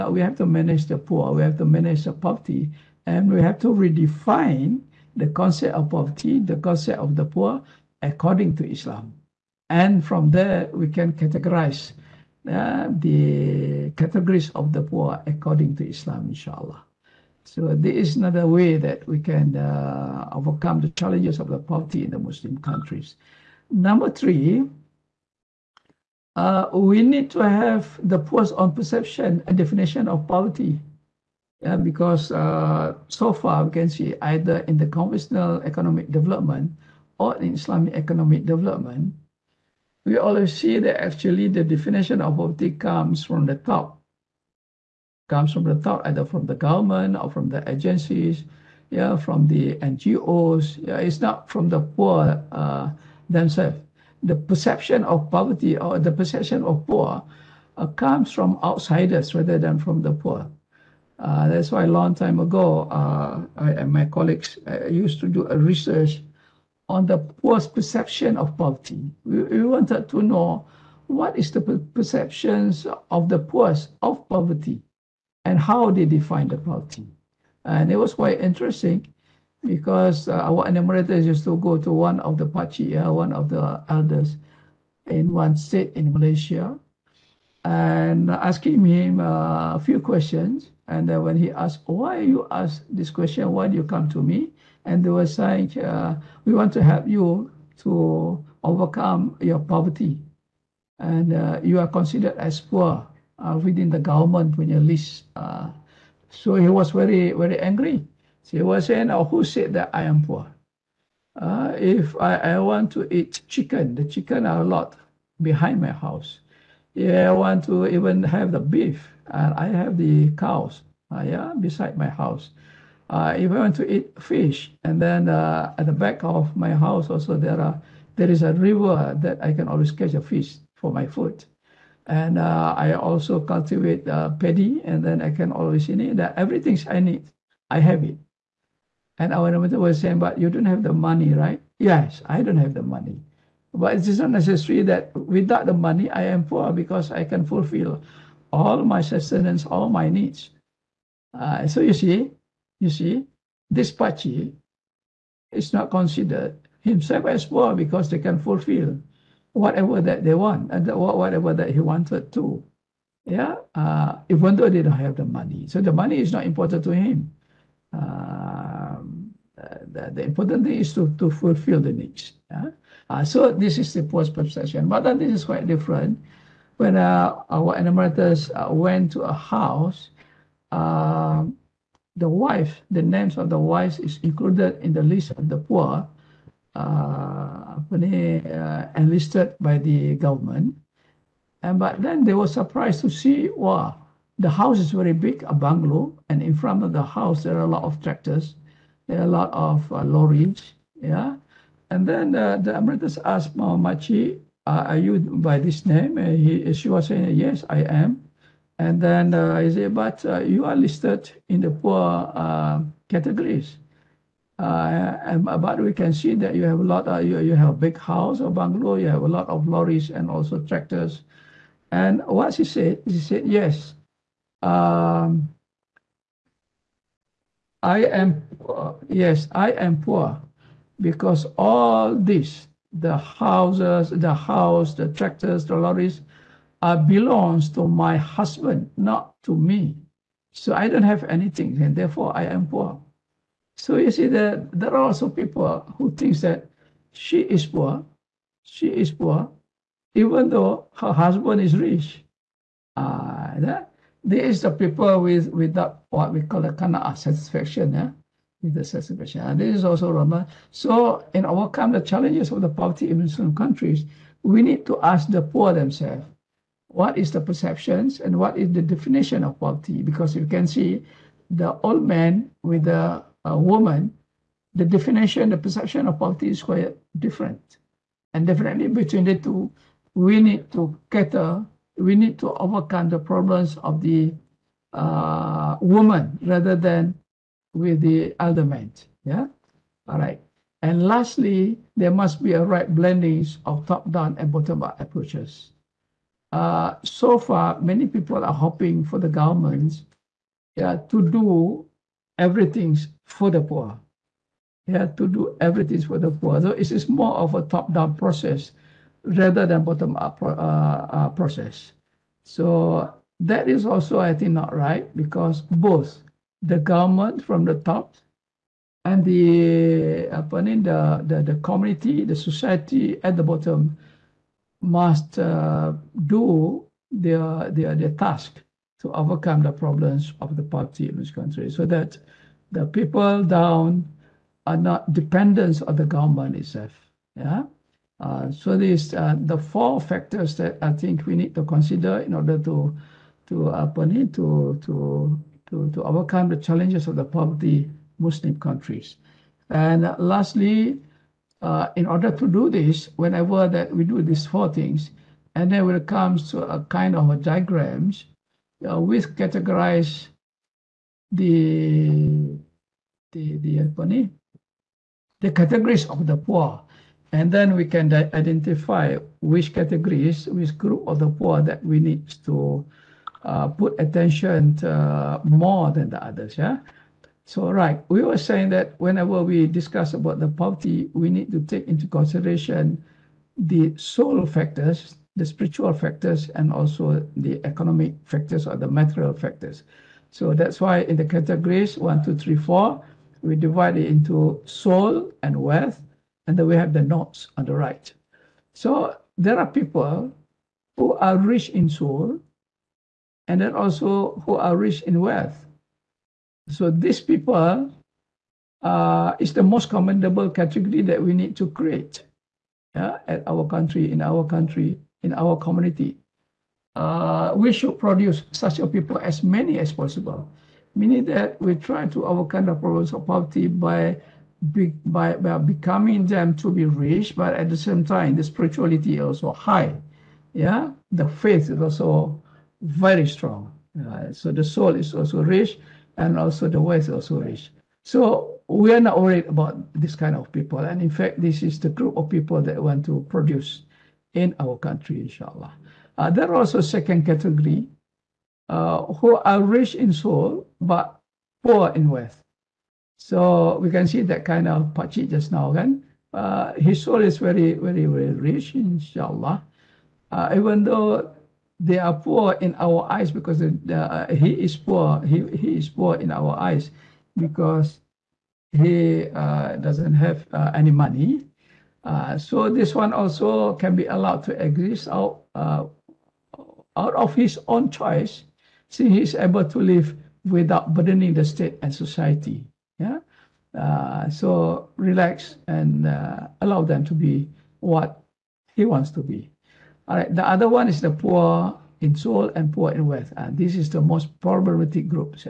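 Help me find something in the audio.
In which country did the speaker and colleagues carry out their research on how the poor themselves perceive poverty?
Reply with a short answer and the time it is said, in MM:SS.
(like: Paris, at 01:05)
Malaysia, at 01:26.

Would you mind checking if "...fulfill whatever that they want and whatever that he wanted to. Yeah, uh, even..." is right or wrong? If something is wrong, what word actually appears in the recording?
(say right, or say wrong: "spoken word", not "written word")
right.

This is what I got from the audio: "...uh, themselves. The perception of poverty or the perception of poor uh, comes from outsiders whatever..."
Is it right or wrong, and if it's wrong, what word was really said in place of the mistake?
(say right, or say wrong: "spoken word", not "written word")
wrong: "rather", not "whatever".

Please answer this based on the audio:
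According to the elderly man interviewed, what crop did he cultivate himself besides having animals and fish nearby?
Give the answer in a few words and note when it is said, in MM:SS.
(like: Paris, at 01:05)
paddy, at 02:14.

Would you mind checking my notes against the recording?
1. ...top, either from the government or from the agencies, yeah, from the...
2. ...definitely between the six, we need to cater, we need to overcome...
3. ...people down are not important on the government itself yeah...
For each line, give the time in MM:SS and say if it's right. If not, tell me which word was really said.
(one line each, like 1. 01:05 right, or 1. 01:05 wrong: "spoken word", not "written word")
1. 00:45 right
2. 04:38 wrong: "two", not "six"
3. 05:32 wrong: "dependent", not "important".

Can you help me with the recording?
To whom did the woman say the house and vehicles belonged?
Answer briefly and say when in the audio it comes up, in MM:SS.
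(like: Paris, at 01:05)
her husband, at 03:57.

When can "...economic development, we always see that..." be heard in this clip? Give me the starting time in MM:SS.
00:37.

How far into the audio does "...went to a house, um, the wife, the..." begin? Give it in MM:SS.
02:58.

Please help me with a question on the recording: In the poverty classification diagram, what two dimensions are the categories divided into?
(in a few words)
soul and wealth.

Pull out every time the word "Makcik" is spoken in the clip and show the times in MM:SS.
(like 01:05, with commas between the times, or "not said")
03:23.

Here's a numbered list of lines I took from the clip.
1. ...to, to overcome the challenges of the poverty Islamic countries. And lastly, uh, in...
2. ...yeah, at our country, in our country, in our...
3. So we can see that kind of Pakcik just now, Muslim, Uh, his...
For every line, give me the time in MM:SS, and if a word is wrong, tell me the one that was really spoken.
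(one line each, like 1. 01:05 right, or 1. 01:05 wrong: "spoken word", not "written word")
1. 05:45 wrong: "Muslim", not "Islamic"
2. 06:52 right
3. 07:33 wrong: "Again", not "Muslim".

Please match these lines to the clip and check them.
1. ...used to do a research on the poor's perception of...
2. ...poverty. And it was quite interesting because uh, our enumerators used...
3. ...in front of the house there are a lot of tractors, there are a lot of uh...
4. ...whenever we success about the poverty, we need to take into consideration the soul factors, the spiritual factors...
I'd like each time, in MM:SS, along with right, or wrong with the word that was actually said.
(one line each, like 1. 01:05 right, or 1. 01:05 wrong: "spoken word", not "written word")
1. 01:04 right
2. 01:16 right
3. 03:16 right
4. 06:18 wrong: "discuss", not "success".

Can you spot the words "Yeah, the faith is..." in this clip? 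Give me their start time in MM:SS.
07:10.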